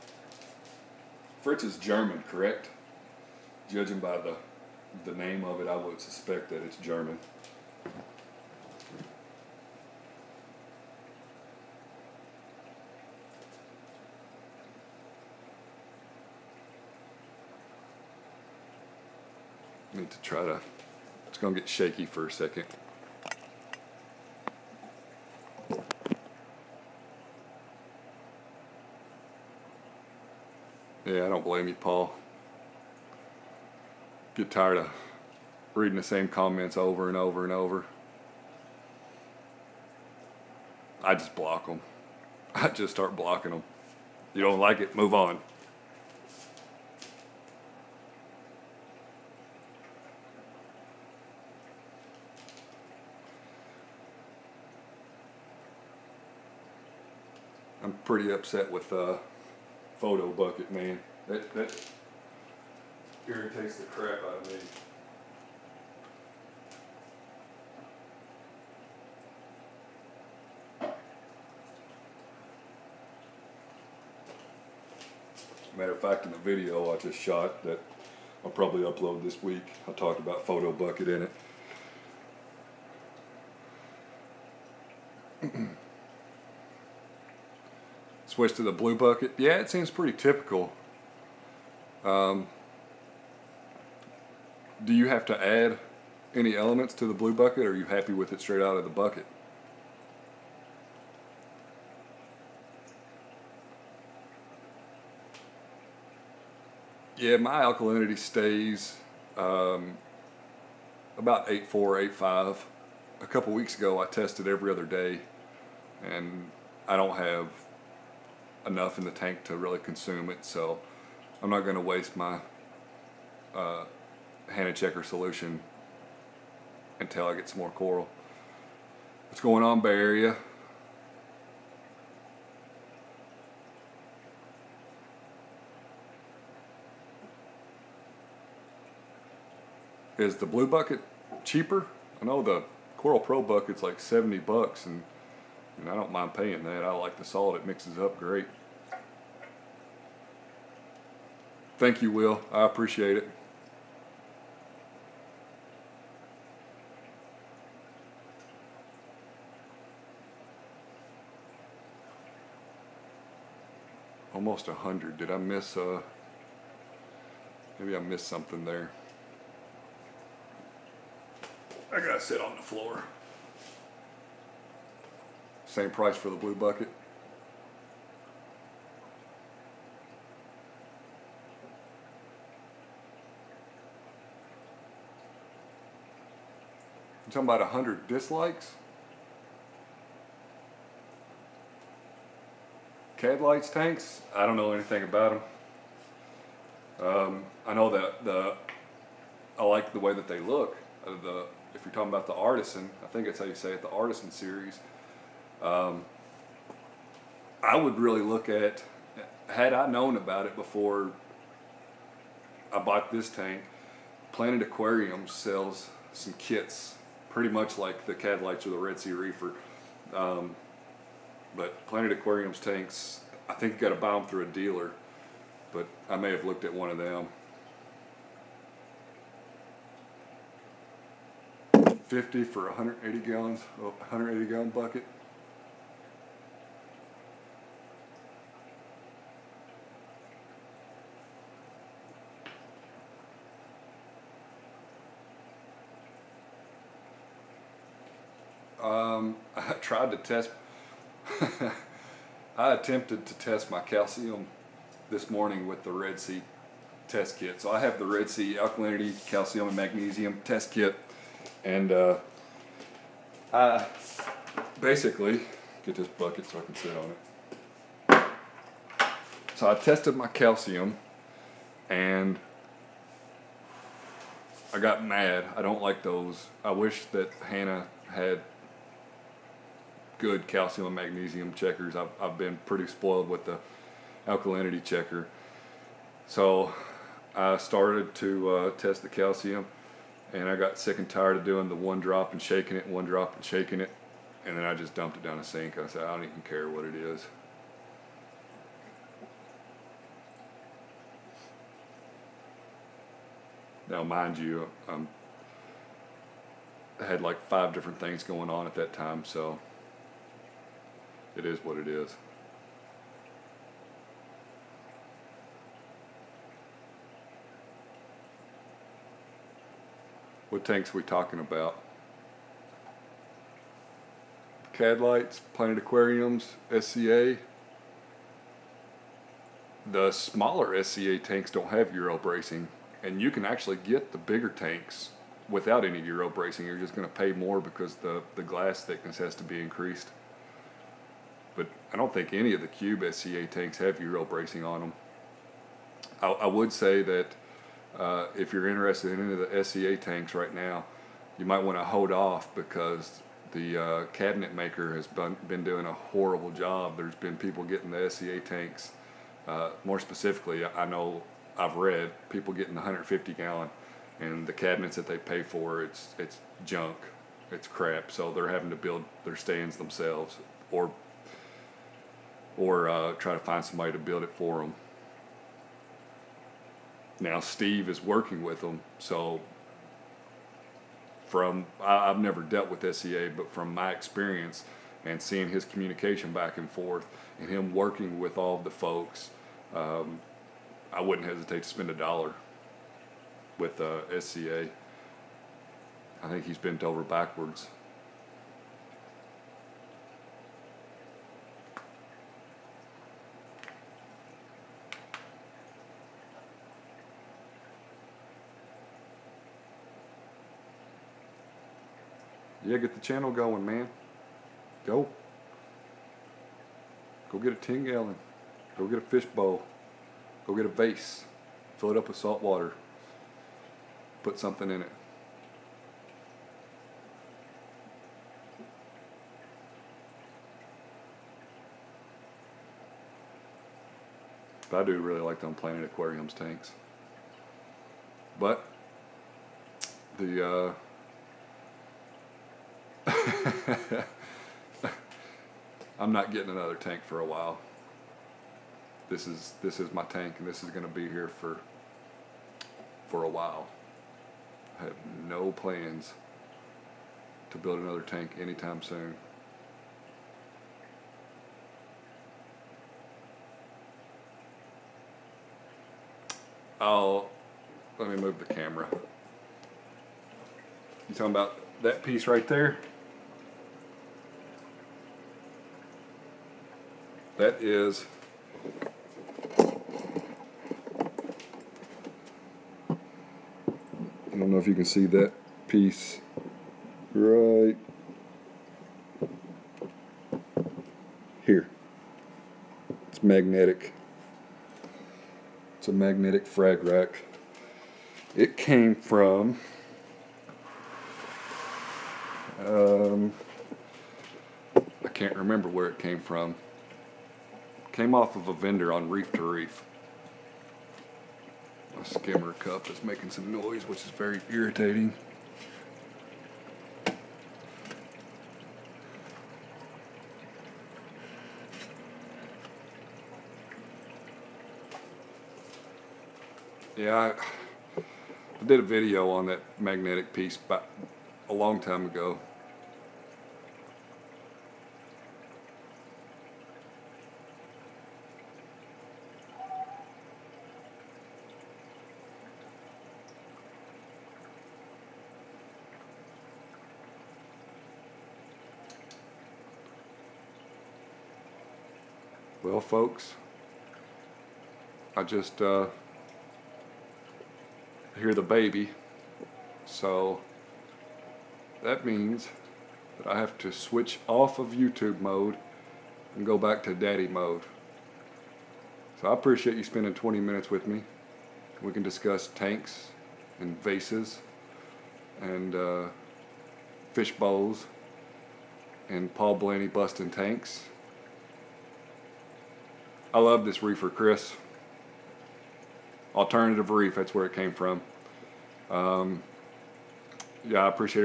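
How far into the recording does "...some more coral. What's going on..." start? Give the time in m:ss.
2:07.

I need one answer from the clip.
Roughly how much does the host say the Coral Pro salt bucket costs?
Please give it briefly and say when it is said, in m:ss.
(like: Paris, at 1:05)
70 bucks, at 2:23.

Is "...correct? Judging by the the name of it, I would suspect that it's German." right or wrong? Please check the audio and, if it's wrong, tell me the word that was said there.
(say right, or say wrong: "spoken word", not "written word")
right.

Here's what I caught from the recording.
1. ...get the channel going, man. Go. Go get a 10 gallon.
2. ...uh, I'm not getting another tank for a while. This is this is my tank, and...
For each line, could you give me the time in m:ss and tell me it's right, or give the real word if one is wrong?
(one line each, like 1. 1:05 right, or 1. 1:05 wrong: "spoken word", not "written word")
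1. 6:52 right
2. 7:20 right.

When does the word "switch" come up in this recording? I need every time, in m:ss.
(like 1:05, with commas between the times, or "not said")
1:28, 9:23.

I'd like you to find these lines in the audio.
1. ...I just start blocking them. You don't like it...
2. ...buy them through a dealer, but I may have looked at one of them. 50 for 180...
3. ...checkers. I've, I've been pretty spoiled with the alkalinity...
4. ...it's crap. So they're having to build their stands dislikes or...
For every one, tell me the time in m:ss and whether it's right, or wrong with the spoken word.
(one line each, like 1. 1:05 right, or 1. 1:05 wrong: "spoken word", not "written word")
1. 0:42 right
2. 3:43 right
3. 4:41 right
4. 6:07 wrong: "themselves", not "dislikes".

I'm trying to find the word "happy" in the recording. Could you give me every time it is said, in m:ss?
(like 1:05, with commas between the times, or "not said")
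1:37.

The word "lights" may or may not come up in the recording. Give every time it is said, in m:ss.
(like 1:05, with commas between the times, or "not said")
3:13, 5:24.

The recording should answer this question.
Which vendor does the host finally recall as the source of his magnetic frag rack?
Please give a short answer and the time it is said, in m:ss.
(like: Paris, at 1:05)
Alternative Reef, at 9:46.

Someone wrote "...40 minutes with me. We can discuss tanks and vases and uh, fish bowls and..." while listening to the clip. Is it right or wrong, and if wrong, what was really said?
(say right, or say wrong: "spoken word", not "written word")
wrong: "20", not "40".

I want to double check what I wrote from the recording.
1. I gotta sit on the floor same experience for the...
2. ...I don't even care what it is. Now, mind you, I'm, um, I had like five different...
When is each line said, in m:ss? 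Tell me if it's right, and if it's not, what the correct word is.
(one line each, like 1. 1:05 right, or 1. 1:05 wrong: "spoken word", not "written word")
1. 2:51 wrong: "price", not "experience"
2. 4:56 right.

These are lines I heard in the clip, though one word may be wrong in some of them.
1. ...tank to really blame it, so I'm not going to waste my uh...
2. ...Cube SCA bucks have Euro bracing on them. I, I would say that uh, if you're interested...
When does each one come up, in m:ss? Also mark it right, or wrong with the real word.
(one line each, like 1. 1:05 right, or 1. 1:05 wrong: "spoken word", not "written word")
1. 1:59 wrong: "consume", not "blame"
2. 5:42 wrong: "tanks", not "bucks".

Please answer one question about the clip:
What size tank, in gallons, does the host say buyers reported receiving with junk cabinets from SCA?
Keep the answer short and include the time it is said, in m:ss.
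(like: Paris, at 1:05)
150 gallon, at 6:02.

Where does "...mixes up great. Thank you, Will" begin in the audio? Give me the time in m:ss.
2:27.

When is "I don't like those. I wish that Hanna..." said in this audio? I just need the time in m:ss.
4:35.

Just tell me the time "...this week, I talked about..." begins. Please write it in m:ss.
1:19.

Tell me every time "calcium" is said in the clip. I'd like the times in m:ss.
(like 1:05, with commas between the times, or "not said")
4:13, 4:19, 4:30, 4:40, 4:49.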